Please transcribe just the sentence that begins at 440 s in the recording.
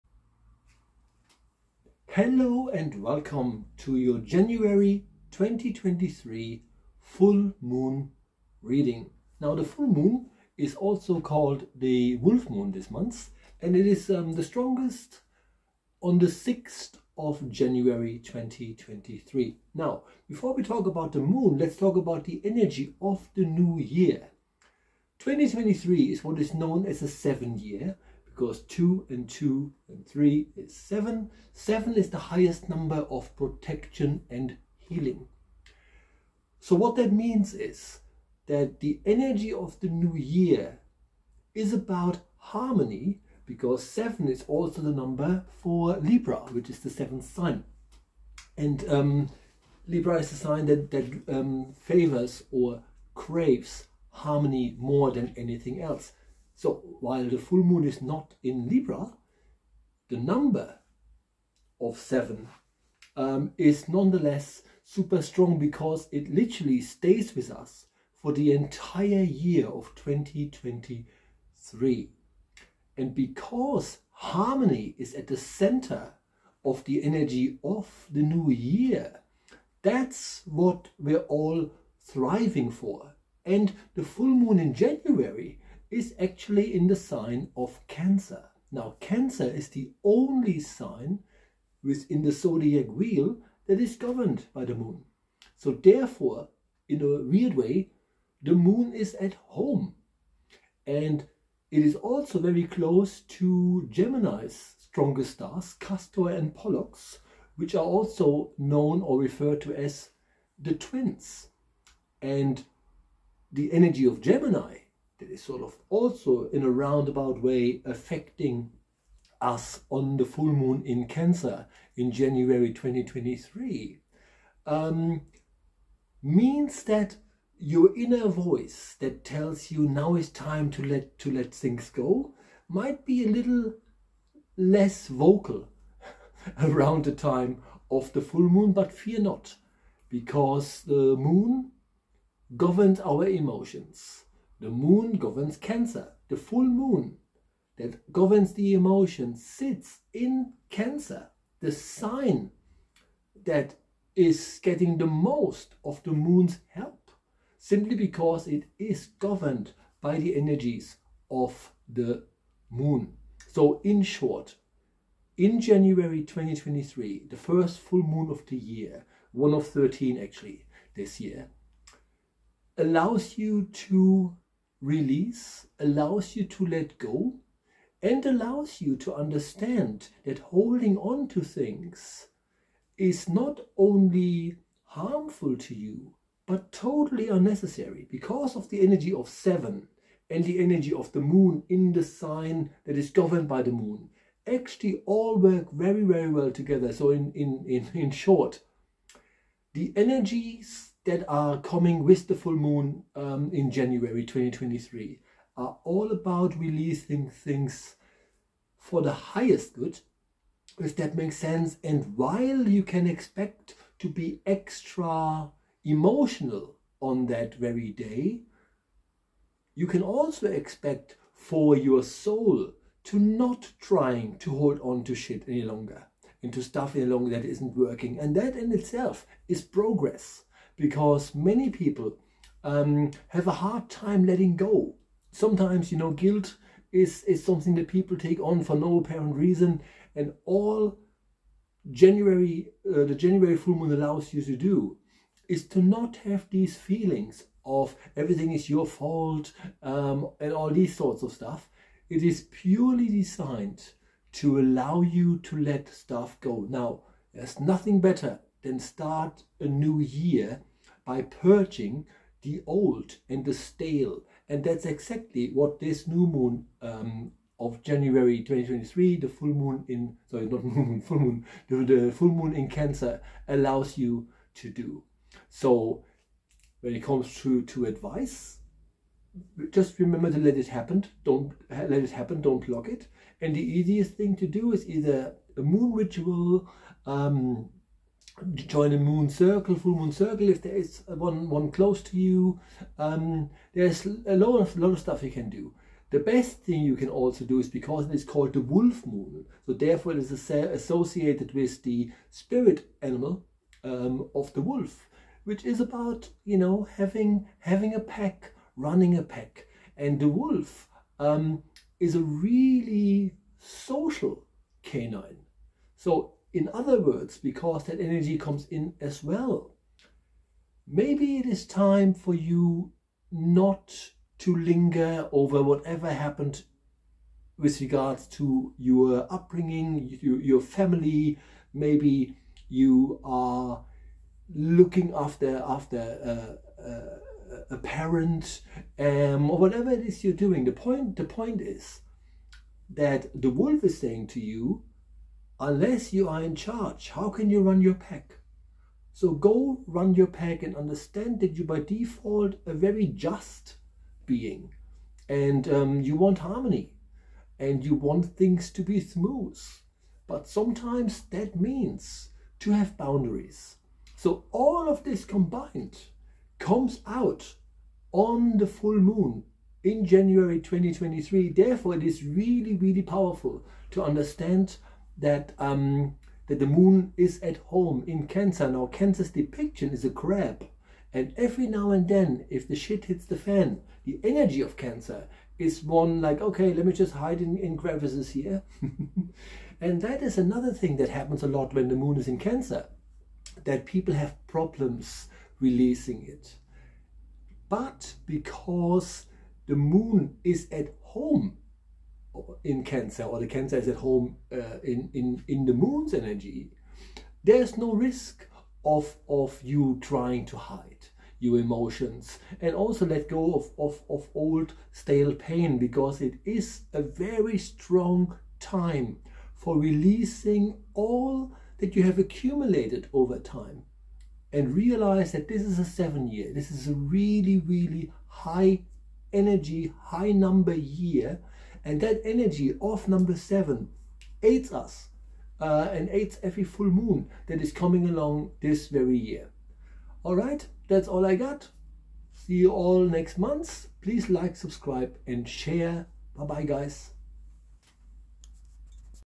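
All right, that's all I got.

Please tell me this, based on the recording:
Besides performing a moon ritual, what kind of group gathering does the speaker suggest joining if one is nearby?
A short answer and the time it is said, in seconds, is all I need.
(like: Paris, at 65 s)
Full moon circle, at 289 s.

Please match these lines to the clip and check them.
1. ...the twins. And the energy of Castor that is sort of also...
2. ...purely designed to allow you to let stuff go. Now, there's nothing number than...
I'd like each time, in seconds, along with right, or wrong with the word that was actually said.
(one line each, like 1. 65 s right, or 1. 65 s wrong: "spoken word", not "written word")
1. 110 s wrong: "Gemini", not "Castor"
2. 252 s wrong: "better", not "number".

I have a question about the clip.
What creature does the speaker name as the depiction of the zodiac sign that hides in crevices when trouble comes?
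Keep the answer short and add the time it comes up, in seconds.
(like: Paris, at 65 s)
A crab, at 380 s.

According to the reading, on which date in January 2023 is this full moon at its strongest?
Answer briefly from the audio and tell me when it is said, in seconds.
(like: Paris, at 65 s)
6th of January, at 16 s.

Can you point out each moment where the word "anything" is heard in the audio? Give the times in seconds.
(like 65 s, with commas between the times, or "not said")
55 s.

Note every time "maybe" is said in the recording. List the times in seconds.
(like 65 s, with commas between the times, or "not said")
320 s, 331 s.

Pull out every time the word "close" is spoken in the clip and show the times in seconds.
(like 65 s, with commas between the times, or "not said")
102 s, 291 s.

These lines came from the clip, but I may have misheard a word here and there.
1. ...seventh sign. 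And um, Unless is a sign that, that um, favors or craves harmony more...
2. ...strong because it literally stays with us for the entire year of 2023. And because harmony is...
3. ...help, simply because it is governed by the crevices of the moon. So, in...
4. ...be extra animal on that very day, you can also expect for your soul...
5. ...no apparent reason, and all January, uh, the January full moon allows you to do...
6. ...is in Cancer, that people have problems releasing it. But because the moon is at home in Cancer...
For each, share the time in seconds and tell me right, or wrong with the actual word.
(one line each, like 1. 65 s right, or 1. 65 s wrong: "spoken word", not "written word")
1. 46 s wrong: "Libra", not "Unless"
2. 65 s right
3. 156 s wrong: "energies", not "crevices"
4. 214 s wrong: "emotional", not "animal"
5. 238 s right
6. 392 s right.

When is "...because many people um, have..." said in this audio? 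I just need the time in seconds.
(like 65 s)
230 s.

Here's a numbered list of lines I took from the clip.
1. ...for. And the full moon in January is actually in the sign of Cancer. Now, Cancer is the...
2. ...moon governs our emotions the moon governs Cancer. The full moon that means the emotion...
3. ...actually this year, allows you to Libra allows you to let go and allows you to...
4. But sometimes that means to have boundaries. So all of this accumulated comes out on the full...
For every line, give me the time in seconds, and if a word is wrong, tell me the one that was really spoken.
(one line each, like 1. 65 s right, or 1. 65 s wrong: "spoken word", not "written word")
1. 82 s right
2. 141 s wrong: "governs", not "means"
3. 170 s wrong: "Release", not "Libra"
4. 360 s wrong: "combined", not "accumulated".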